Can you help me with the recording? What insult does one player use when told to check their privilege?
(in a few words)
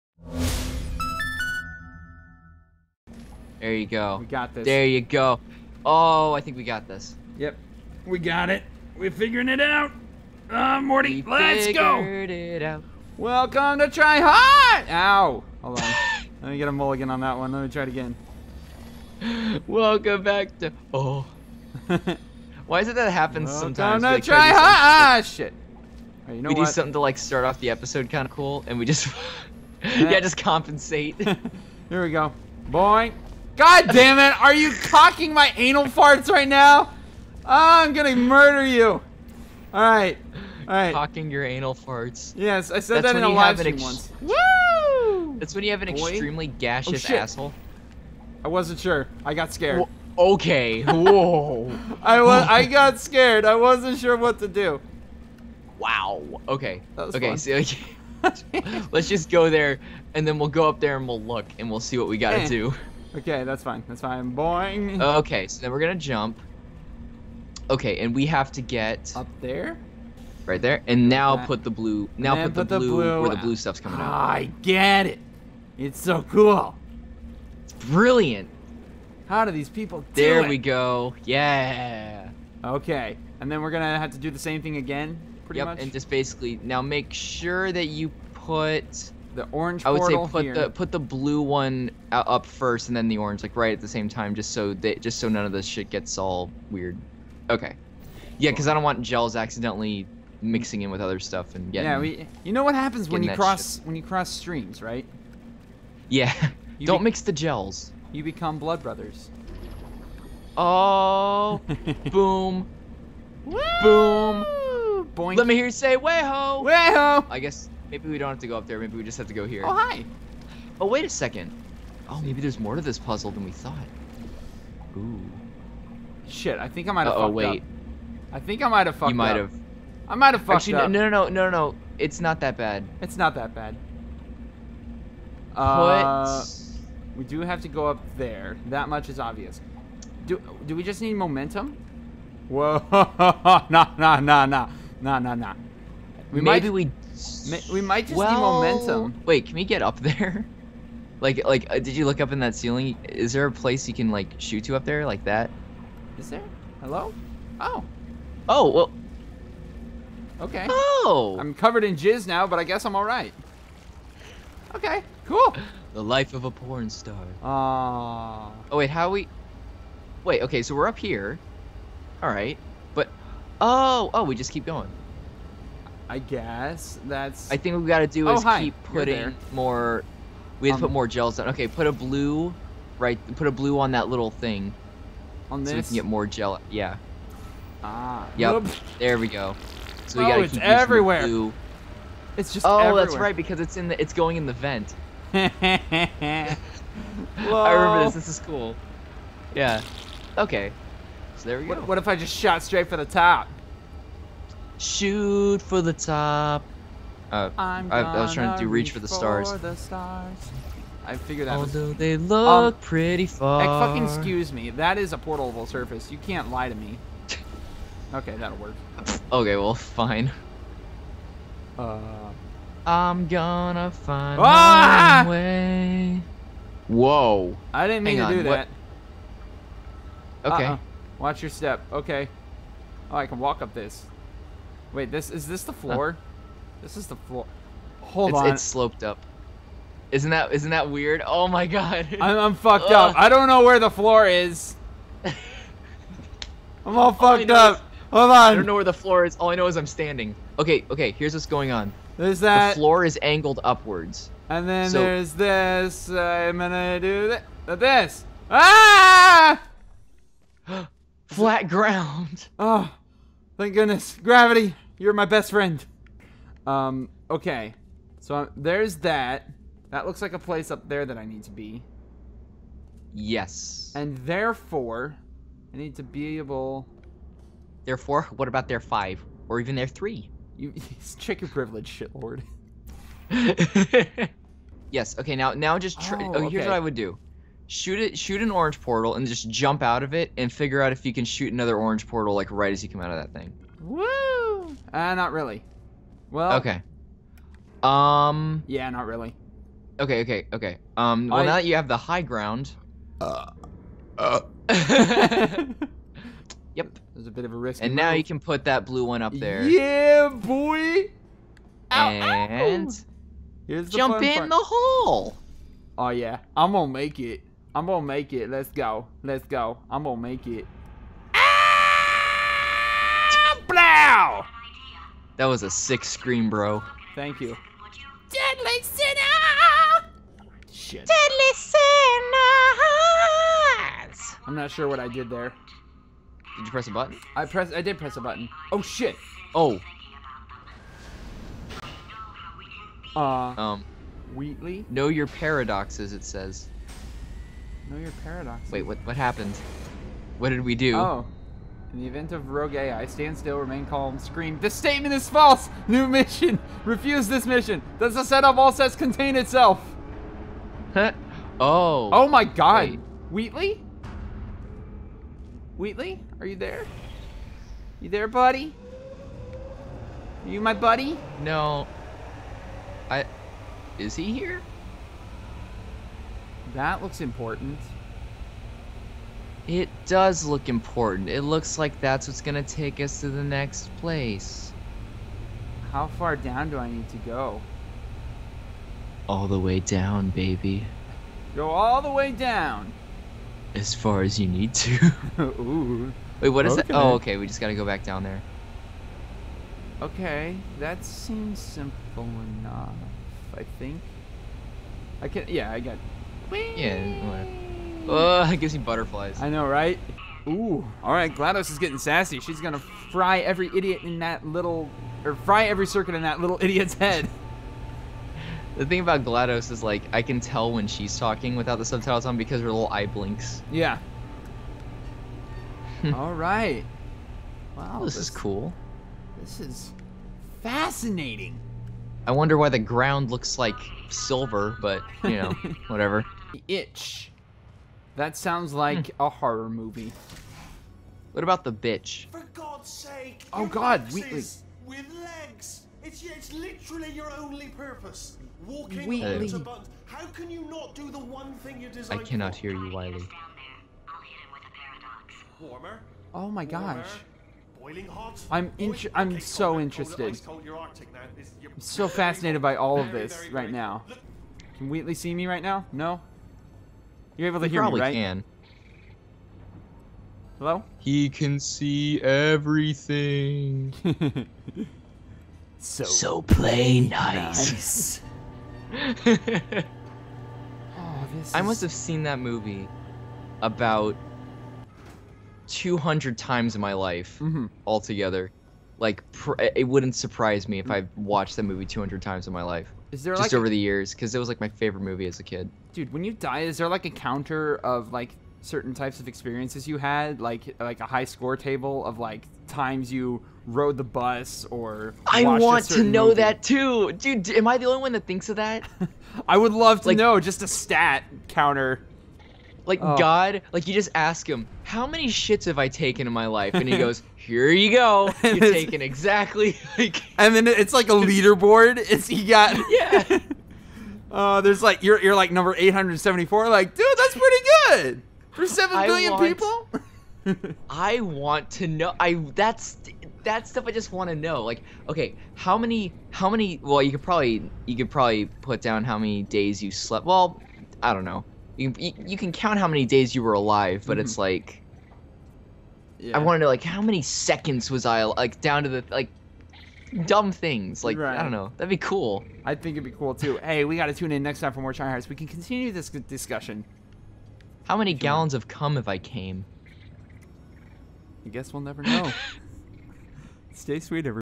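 Shitlord.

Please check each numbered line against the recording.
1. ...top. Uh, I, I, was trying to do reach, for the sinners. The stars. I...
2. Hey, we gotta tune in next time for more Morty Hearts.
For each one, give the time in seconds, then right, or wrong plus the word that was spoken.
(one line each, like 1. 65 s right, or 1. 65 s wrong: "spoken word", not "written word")
1. 205 s wrong: "stars", not "sinners"
2. 553 s wrong: "China", not "Morty".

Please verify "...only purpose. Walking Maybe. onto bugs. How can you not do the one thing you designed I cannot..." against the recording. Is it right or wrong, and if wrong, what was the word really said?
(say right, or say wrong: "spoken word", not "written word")
wrong: "Wheatley", not "Maybe".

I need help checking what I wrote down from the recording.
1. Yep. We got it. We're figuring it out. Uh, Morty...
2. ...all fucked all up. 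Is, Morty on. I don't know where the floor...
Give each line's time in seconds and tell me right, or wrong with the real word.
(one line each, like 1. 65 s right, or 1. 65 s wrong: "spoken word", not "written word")
1. 7 s right
2. 246 s wrong: "Hold", not "Morty".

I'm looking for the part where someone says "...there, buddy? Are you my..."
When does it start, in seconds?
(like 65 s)
368 s.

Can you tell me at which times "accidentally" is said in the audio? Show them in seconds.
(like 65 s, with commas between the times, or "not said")
99 s.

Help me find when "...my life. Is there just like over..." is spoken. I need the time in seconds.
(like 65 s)
492 s.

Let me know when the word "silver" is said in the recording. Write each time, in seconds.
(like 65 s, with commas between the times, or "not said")
434 s.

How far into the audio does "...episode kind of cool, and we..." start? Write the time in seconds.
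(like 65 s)
27 s.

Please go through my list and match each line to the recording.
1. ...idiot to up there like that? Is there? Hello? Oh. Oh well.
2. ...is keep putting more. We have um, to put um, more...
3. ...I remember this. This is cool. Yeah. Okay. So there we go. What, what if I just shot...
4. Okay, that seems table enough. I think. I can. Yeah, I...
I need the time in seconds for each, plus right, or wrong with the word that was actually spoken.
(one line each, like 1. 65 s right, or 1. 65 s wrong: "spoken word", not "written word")
1. 154 s wrong: "shoot", not "idiot"
2. 178 s right
3. 195 s right
4. 400 s wrong: "simple", not "table".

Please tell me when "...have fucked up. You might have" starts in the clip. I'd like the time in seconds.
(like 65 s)
128 s.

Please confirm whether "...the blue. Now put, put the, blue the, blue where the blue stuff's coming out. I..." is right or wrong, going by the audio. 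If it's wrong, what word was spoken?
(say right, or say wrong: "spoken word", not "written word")
right.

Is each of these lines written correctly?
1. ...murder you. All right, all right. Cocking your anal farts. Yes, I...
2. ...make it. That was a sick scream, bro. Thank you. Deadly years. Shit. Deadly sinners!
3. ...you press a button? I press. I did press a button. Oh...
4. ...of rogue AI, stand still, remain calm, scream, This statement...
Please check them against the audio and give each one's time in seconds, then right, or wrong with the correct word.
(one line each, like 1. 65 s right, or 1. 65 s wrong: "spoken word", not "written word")
1. 38 s right
2. 320 s wrong: "sinners", not "years"
3. 336 s right
4. 352 s right.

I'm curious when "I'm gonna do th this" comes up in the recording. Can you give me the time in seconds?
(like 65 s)
256 s.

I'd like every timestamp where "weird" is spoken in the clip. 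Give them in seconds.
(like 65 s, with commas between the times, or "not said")
96 s, 240 s.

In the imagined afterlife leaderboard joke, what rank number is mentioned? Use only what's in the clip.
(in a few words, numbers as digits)
874.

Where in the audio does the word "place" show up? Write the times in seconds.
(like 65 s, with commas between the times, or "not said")
153 s, 270 s, 383 s.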